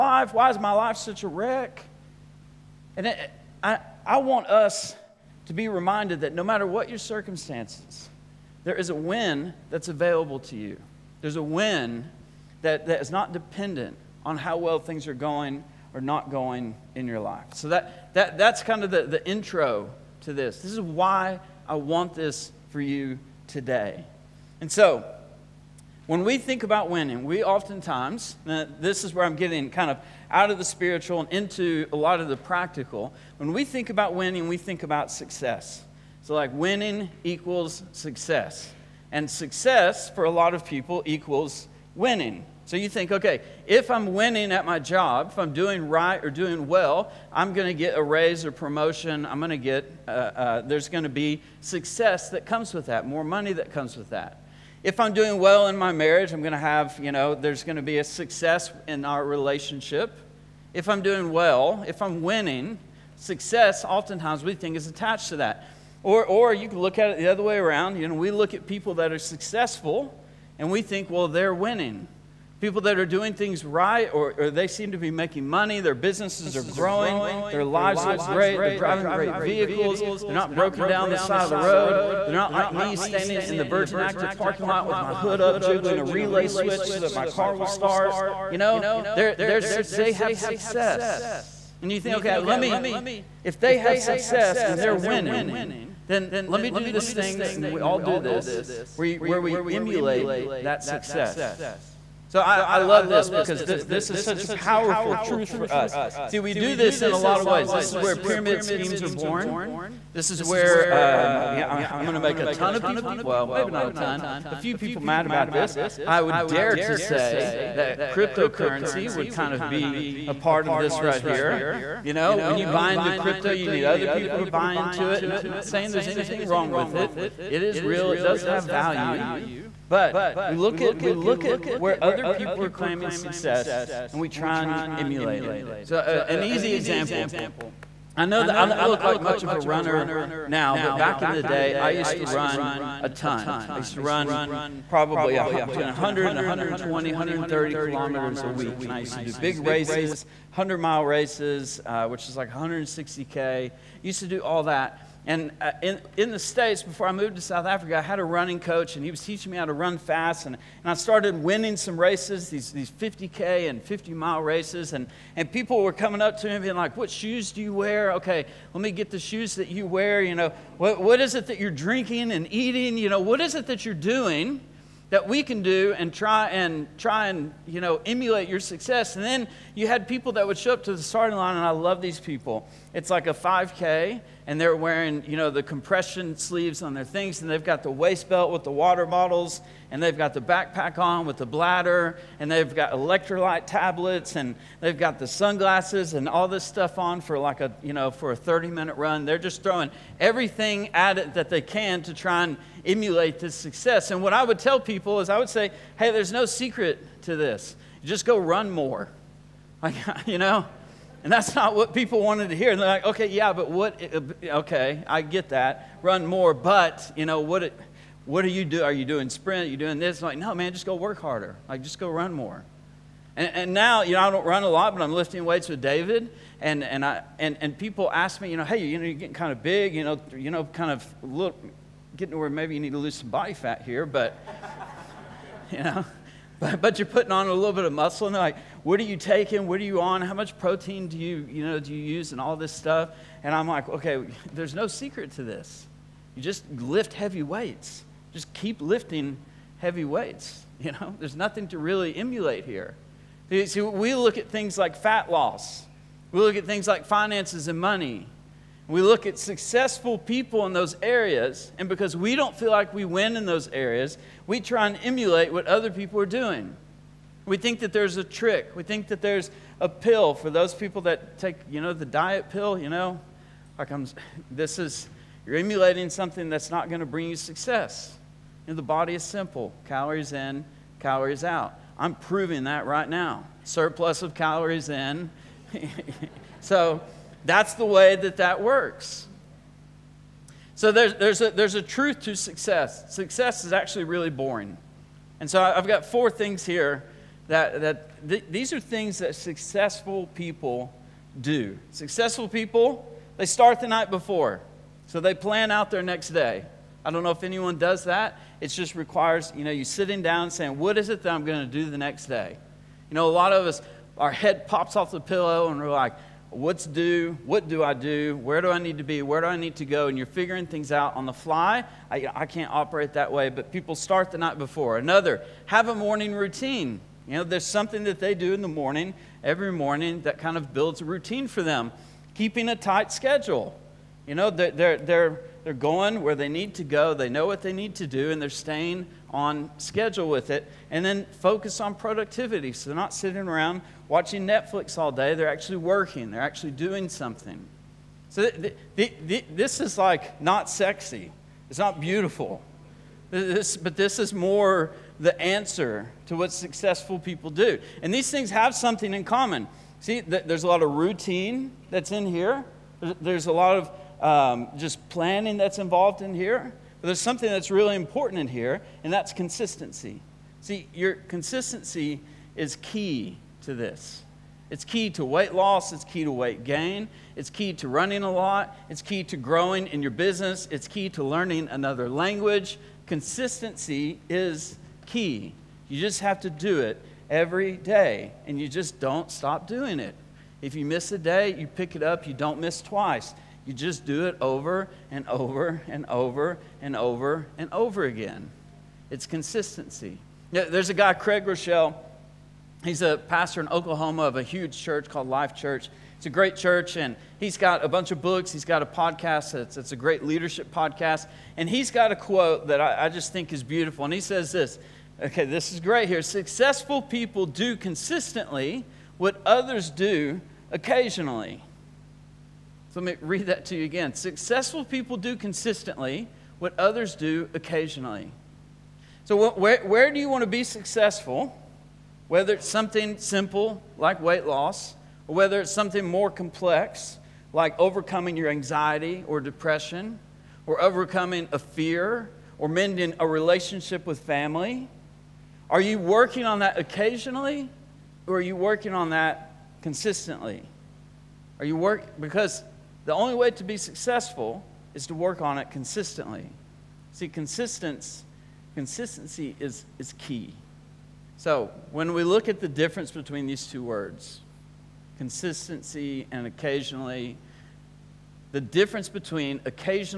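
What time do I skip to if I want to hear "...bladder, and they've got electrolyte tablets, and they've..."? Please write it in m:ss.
3:11.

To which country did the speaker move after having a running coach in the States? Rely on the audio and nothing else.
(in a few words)
South Africa.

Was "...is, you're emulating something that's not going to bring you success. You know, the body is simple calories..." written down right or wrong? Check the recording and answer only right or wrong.
right.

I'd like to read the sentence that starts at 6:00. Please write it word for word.
See, th- there's a lot of routine that's in here, there's a lot of um, just planning that's involved in here.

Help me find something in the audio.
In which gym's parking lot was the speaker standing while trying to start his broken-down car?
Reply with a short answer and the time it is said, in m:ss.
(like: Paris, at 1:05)
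Virgin Active, at 1:23.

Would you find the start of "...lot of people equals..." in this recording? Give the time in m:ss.
0:40.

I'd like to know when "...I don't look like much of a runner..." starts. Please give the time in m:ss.
2:18.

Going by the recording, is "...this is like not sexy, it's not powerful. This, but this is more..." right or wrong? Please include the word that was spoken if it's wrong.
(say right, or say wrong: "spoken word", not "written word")
wrong: "beautiful", not "powerful".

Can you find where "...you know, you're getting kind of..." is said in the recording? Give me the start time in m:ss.
3:48.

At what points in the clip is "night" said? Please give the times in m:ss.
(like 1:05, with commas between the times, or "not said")
5:03, 5:24.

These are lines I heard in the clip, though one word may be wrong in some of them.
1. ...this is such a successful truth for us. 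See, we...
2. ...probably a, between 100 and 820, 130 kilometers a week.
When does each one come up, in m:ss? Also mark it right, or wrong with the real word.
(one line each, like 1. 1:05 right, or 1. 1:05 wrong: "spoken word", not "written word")
1. 1:43 wrong: "powerful", not "successful"
2. 2:24 wrong: "120", not "820".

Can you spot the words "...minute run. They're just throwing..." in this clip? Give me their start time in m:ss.
3:18.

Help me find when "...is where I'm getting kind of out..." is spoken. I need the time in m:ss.
0:29.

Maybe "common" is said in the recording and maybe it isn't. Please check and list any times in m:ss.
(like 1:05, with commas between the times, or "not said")
5:59.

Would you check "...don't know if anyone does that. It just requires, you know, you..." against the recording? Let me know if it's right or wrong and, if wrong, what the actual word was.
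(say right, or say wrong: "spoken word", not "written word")
right.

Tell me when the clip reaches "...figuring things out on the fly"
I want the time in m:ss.
5:20.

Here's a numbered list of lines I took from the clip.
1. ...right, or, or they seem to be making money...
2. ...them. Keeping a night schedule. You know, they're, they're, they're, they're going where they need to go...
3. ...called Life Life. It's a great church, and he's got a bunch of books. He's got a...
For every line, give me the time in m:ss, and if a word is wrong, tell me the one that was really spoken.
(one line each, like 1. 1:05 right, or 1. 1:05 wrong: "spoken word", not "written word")
1. 1:13 right
2. 5:31 wrong: "tight", not "night"
3. 6:45 wrong: "Church", not "Life".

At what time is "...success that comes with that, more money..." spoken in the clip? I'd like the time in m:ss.
0:51.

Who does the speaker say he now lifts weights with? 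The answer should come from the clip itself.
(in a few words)
David.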